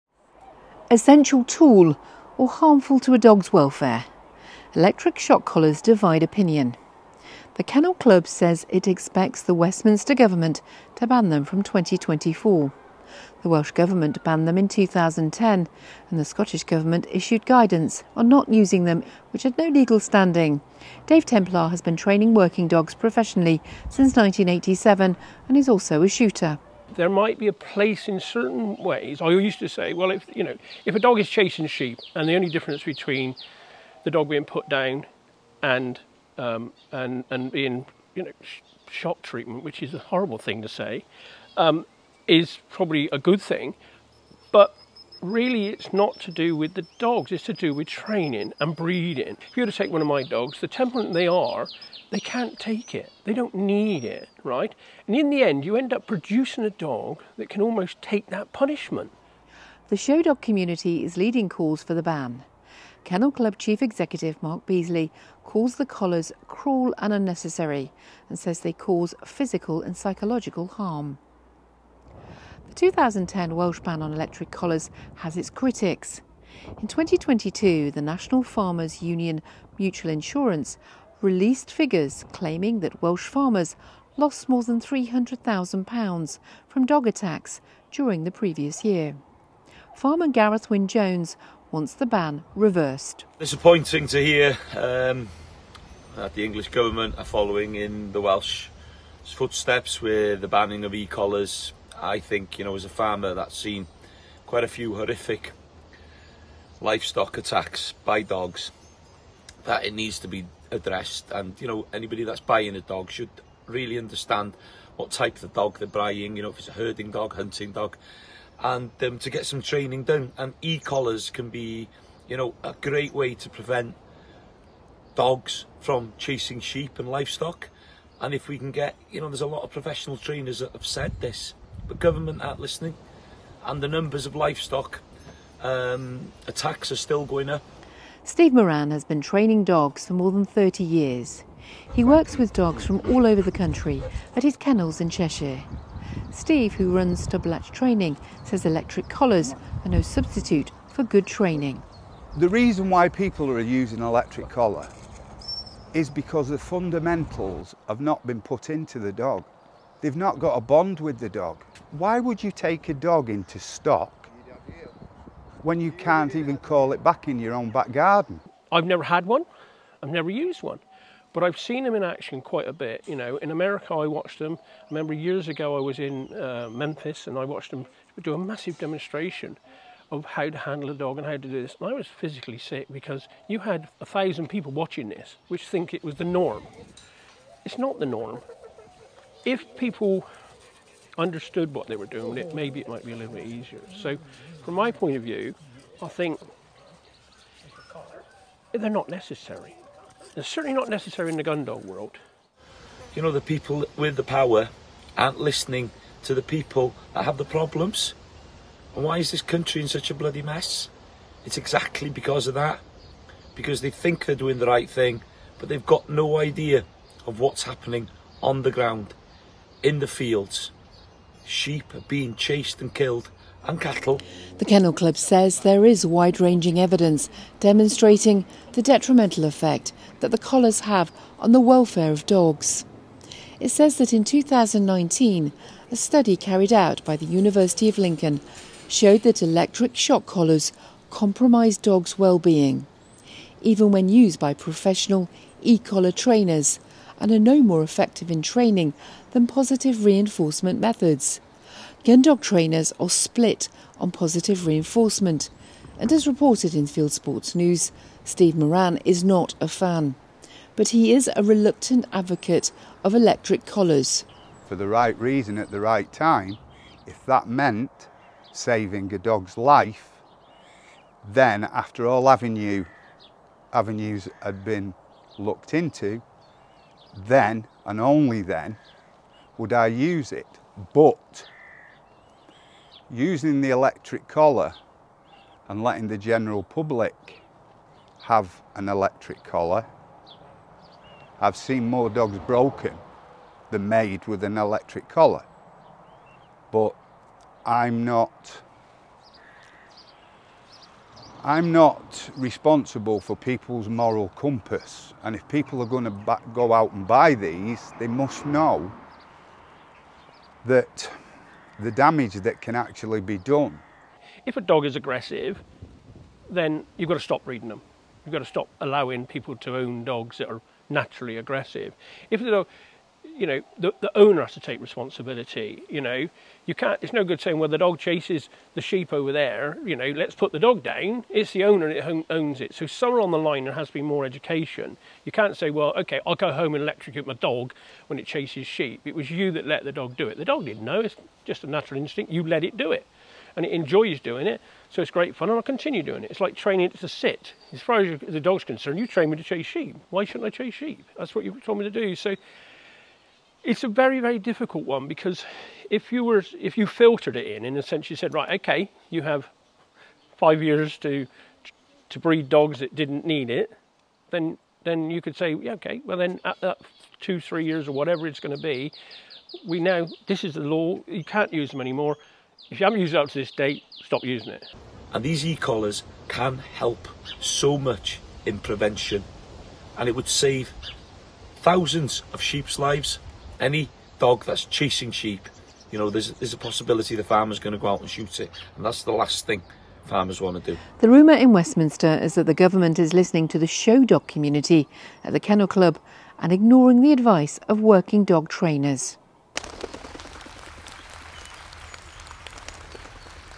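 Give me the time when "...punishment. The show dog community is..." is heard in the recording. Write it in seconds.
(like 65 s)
58 s.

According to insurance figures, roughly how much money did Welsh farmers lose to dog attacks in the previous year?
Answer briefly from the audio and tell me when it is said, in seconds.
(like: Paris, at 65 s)
£300,000, at 84 s.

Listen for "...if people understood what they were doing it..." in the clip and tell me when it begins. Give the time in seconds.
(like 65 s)
189 s.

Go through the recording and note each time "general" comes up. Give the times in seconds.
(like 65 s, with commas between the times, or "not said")
286 s.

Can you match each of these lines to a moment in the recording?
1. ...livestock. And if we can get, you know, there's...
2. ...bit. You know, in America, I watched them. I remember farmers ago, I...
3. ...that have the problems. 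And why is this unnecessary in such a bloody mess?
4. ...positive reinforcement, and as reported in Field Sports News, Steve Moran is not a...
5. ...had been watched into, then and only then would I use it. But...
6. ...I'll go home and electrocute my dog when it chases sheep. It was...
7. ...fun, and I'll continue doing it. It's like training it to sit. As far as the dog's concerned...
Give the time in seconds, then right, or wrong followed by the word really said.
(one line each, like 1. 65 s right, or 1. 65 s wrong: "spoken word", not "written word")
1. 127 s right
2. 172 s wrong: "years", not "farmers"
3. 207 s wrong: "country", not "unnecessary"
4. 254 s right
5. 274 s wrong: "looked", not "watched"
6. 336 s right
7. 345 s right.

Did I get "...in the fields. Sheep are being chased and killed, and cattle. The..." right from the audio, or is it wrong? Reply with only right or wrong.
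right.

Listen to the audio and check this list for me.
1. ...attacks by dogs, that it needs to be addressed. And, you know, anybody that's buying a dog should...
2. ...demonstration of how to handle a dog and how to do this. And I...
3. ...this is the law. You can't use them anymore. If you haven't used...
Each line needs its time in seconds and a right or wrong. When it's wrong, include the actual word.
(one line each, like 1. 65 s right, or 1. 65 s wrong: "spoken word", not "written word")
1. 107 s right
2. 178 s right
3. 370 s right.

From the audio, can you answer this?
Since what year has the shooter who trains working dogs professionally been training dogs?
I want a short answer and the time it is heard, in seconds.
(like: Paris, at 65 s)
1987, at 24 s.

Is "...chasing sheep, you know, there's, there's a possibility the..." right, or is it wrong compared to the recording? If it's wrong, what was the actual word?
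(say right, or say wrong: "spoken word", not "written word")
right.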